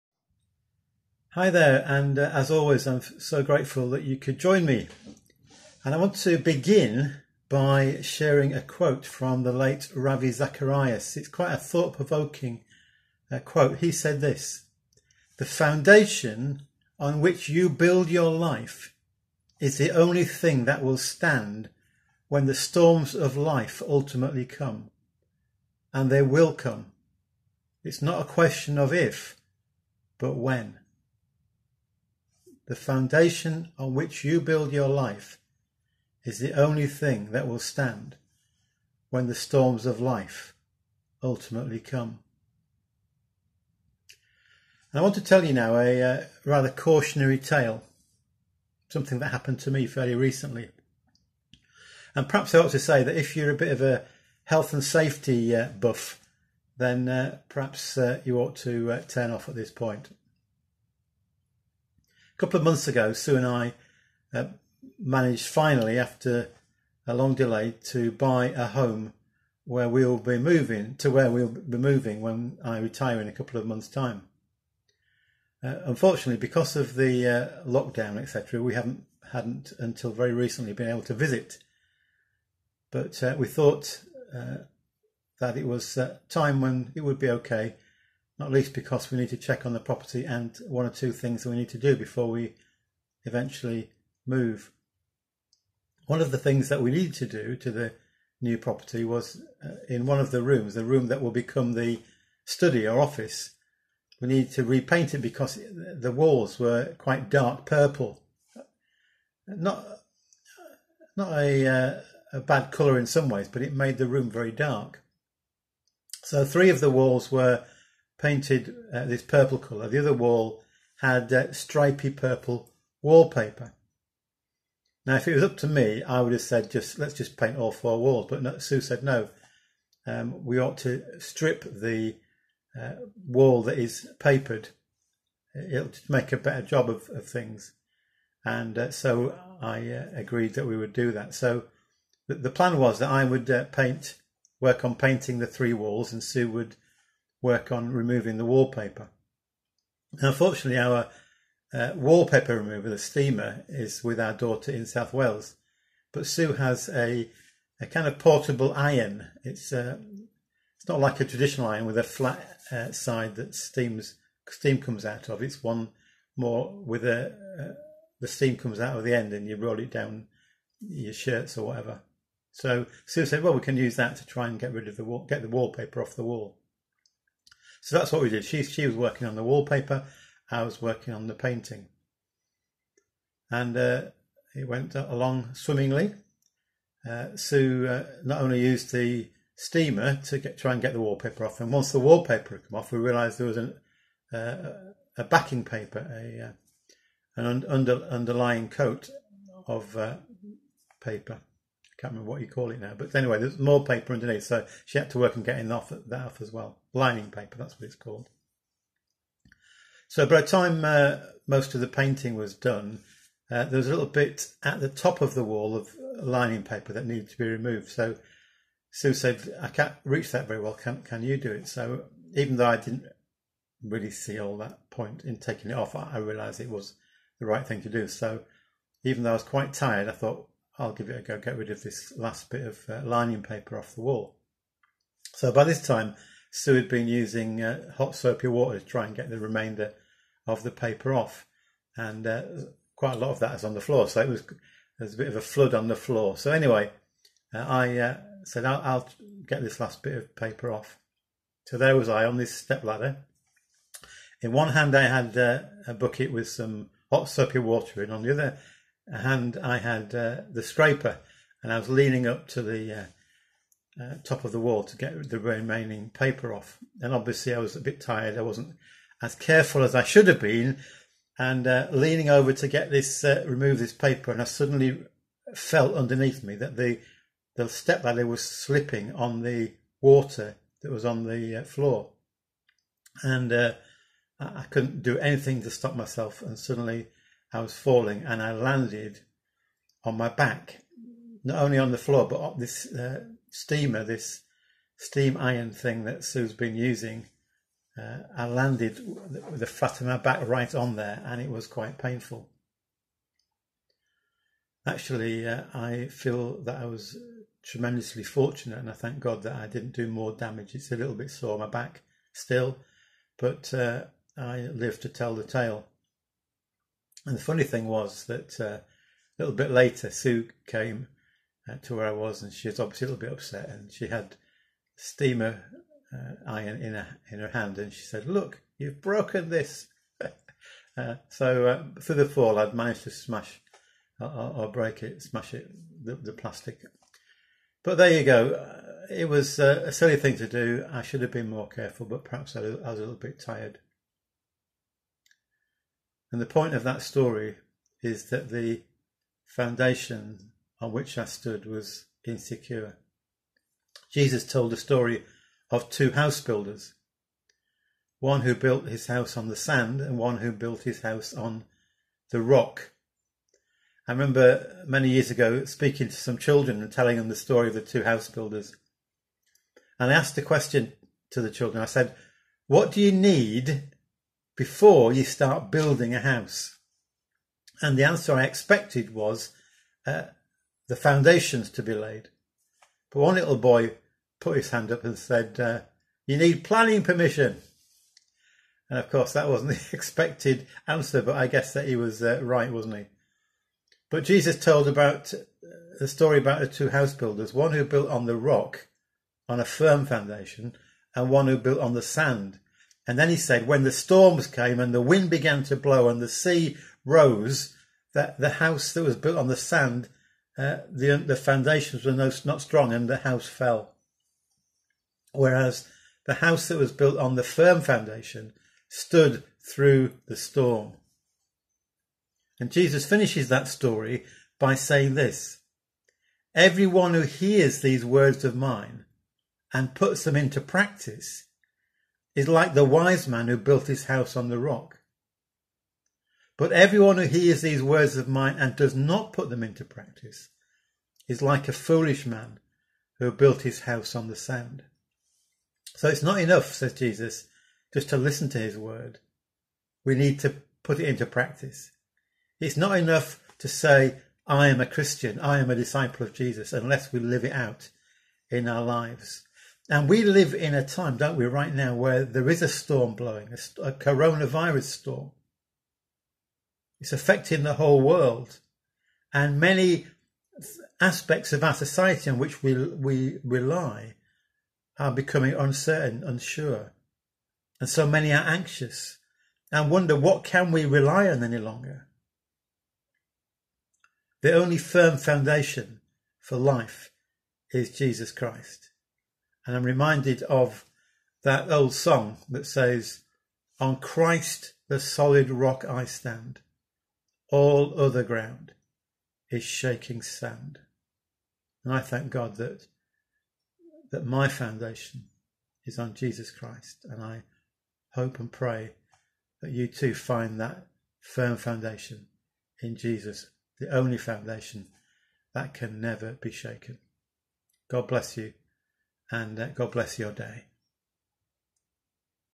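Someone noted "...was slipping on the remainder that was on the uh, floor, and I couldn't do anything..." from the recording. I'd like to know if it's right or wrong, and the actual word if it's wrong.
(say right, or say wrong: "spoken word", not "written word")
wrong: "water", not "remainder".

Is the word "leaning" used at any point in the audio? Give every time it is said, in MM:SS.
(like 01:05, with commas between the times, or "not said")
04:21, 04:31.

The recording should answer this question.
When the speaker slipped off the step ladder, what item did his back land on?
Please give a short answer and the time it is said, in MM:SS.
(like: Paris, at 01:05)
steam iron, at 04:54.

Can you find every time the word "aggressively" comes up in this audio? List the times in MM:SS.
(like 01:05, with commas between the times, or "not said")
not said.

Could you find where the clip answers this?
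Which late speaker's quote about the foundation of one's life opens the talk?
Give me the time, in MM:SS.
00:09.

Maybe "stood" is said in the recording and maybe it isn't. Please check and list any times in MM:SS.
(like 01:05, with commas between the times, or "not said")
05:51, 06:58.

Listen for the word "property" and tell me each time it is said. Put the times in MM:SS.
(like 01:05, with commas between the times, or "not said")
01:29, 01:38.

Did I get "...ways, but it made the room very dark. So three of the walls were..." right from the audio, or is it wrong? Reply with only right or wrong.
right.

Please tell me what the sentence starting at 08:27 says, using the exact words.
And I hope and pray that you too find that firm foundation in Jesus, the only foundation that can never be shaken.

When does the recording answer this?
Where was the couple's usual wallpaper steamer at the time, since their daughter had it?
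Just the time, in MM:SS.
02:34.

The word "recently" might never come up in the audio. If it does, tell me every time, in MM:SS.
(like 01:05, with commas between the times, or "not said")
00:50, 01:20.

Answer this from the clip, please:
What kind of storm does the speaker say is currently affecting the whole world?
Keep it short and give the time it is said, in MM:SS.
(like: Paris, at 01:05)
coronavirus storm, at 07:43.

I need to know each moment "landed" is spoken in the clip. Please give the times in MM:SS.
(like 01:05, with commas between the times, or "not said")
04:48, 04:58.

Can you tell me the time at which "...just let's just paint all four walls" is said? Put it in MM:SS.
02:06.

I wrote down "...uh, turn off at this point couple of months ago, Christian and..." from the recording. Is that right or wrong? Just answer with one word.
wrong.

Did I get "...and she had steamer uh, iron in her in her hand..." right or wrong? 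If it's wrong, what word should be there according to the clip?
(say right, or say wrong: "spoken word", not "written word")
right.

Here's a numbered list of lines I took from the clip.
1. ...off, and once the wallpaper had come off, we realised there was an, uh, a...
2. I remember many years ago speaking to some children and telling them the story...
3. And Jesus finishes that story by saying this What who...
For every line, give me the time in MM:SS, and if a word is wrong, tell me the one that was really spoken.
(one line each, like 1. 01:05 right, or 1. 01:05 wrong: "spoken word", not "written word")
1. 03:11 right
2. 06:04 right
3. 07:02 wrong: "Everyone", not "What".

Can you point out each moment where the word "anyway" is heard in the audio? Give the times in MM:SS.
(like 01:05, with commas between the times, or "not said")
03:23, 04:06.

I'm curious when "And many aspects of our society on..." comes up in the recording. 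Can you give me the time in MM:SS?
07:49.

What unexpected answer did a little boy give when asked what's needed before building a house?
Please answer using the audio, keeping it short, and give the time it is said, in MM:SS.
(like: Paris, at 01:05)
Planning permission, at 06:26.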